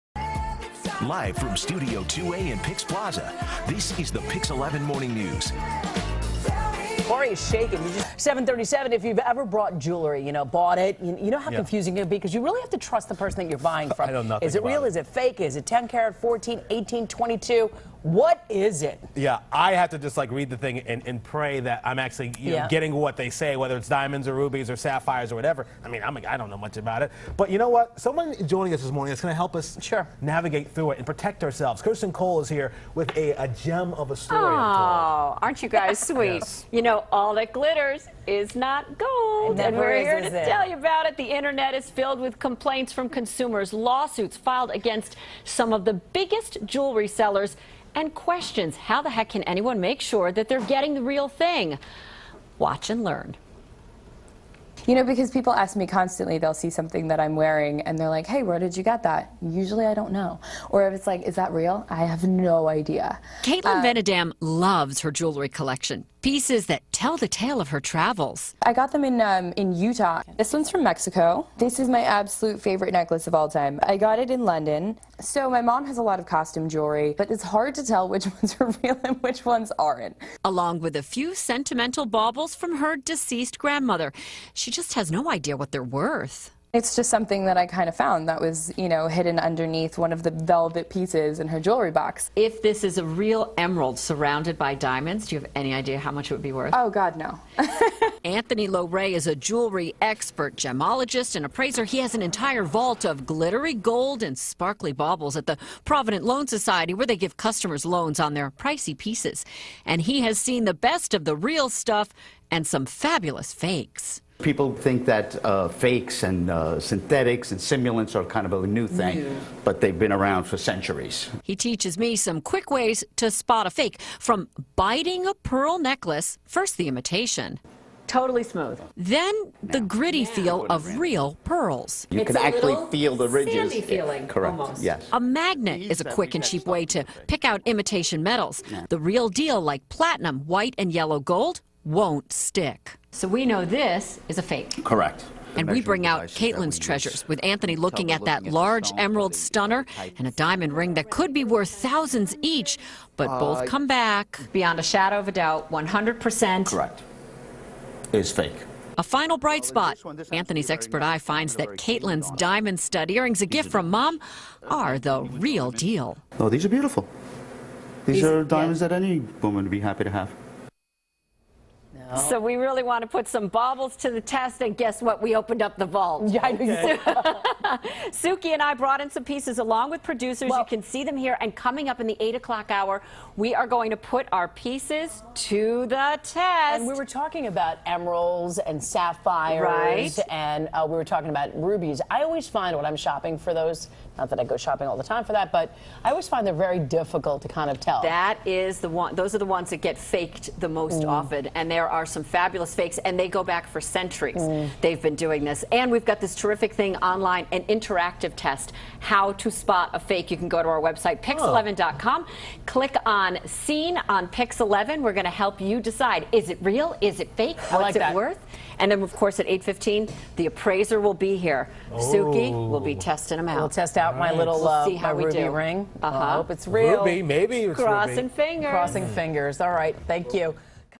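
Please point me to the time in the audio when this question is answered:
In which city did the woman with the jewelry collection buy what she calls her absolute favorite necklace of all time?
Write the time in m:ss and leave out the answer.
1:14.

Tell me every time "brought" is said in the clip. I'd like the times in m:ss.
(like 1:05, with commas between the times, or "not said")
0:09, 2:58.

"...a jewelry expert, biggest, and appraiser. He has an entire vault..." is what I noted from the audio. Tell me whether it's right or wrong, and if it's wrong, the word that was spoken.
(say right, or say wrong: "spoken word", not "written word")
wrong: "gemologist", not "biggest".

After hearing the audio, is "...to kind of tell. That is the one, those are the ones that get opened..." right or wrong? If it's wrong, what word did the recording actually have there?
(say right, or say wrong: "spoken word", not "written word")
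wrong: "faked", not "opened".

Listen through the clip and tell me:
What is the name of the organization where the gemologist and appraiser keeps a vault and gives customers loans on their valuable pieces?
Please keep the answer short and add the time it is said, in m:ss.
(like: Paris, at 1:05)
Provident Loan Society, at 1:45.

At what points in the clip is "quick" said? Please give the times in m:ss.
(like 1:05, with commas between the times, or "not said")
2:02, 2:16.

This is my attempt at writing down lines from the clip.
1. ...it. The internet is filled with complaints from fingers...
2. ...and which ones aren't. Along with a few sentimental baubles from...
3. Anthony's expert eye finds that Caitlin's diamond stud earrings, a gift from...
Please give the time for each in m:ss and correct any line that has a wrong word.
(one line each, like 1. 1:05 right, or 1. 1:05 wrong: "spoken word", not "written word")
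1. 0:41 wrong: "consumers", not "fingers"
2. 1:19 right
3. 2:40 right.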